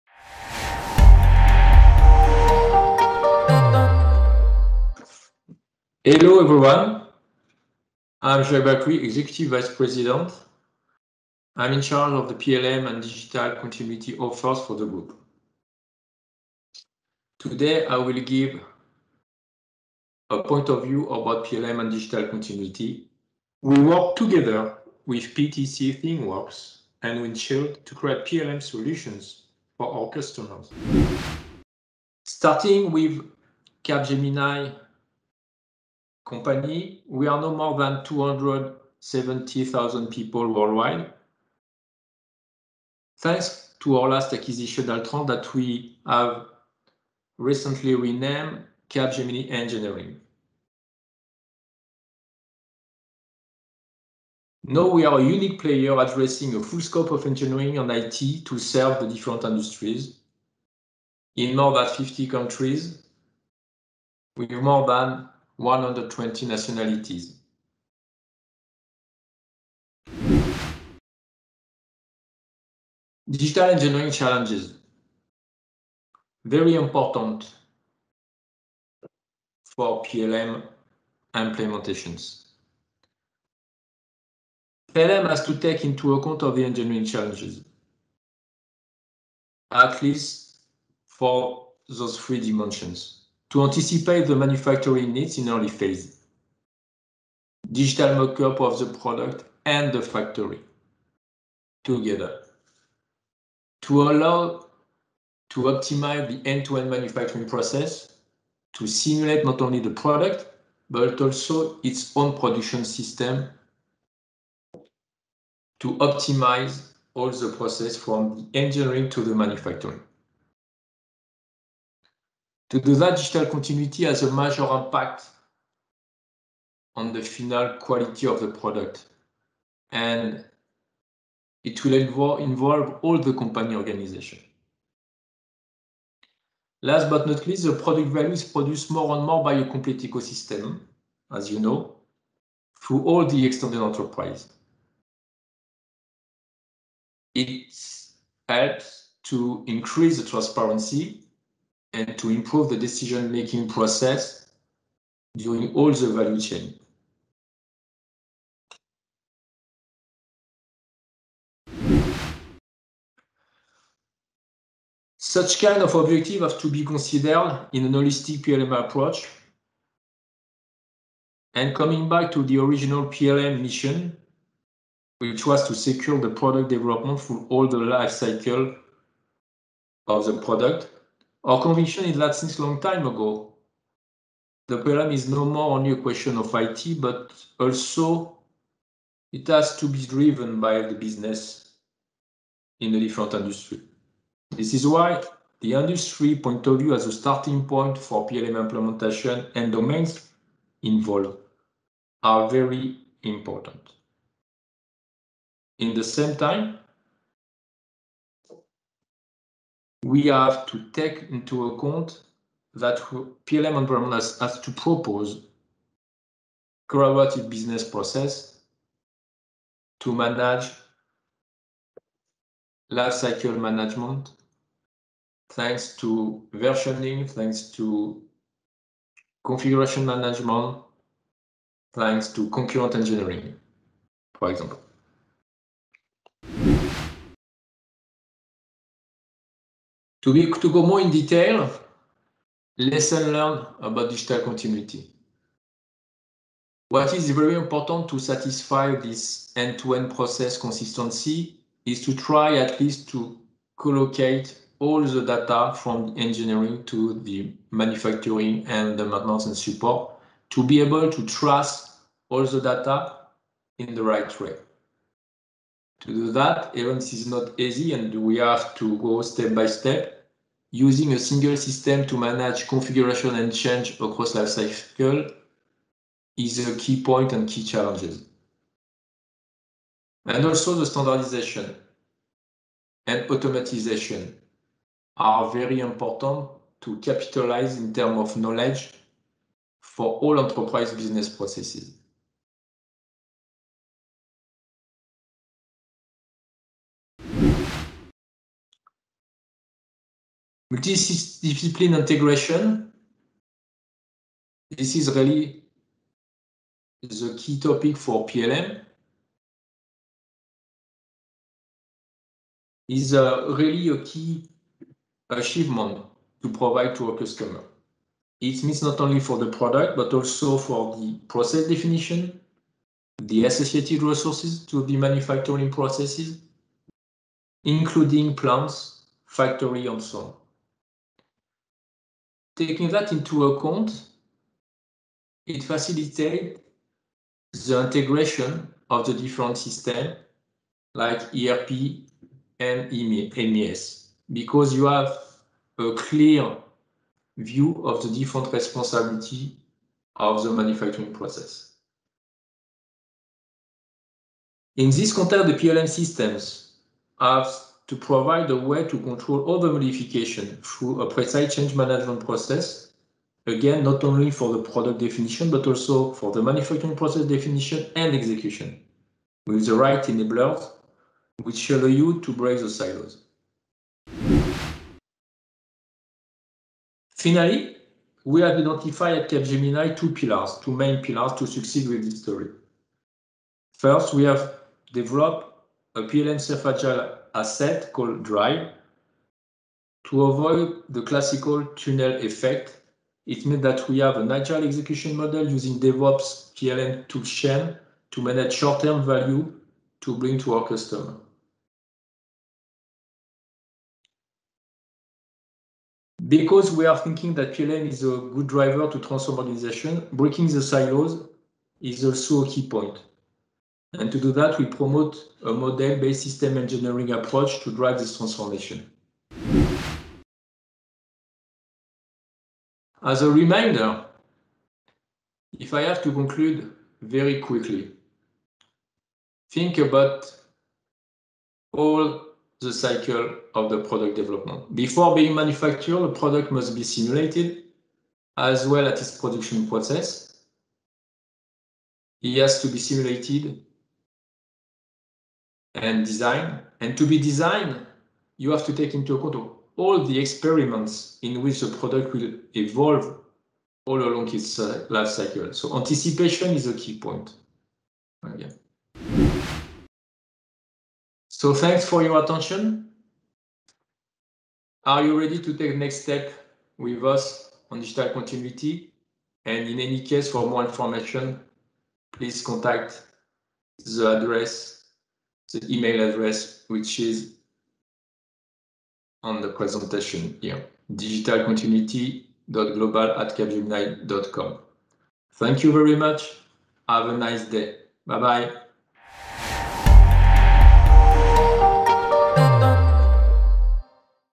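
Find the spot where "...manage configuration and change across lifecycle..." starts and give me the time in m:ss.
4:32.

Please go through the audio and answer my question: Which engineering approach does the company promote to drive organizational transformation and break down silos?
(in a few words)
model-based system engineering.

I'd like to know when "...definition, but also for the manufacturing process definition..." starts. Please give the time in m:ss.
6:04.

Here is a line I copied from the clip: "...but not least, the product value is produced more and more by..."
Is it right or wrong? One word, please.
right.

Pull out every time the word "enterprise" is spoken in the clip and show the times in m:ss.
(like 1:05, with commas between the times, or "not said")
2:23, 4:50.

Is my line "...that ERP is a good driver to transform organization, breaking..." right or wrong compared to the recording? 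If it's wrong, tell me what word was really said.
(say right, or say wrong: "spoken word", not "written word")
wrong: "PLM", not "ERP".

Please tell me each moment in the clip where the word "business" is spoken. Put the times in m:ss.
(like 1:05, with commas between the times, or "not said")
3:10, 3:37, 4:50.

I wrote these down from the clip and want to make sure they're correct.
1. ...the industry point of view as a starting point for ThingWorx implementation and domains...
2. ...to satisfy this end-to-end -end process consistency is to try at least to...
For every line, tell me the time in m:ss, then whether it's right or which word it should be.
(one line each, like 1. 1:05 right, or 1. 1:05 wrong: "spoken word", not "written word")
1. 3:15 wrong: "PLM", not "ThingWorx"
2. 4:08 right.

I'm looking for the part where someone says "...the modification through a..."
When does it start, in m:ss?
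5:59.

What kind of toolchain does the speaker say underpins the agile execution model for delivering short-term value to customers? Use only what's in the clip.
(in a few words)
DevOps PLM toolchain.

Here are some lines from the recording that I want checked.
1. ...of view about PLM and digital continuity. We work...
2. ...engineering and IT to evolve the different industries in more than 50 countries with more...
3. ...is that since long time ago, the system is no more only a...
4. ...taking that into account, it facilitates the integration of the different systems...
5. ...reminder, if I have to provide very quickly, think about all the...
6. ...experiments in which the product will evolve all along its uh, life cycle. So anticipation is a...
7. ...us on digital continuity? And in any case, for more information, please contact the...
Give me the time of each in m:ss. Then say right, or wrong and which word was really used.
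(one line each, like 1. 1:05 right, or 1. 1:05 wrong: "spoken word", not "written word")
1. 0:20 right
2. 0:57 wrong: "serve", not "evolve"
3. 3:02 wrong: "problem", not "system"
4. 5:32 right
5. 7:03 wrong: "conclude", not "provide"
6. 7:30 right
7. 7:47 right.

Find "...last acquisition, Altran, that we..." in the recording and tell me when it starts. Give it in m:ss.
0:44.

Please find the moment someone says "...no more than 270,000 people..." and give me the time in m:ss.
0:37.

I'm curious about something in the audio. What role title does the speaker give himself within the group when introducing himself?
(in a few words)
Executive Vice President.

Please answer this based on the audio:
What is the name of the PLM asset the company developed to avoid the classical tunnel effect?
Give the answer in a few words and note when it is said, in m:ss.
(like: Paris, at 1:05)
DRY, at 6:28.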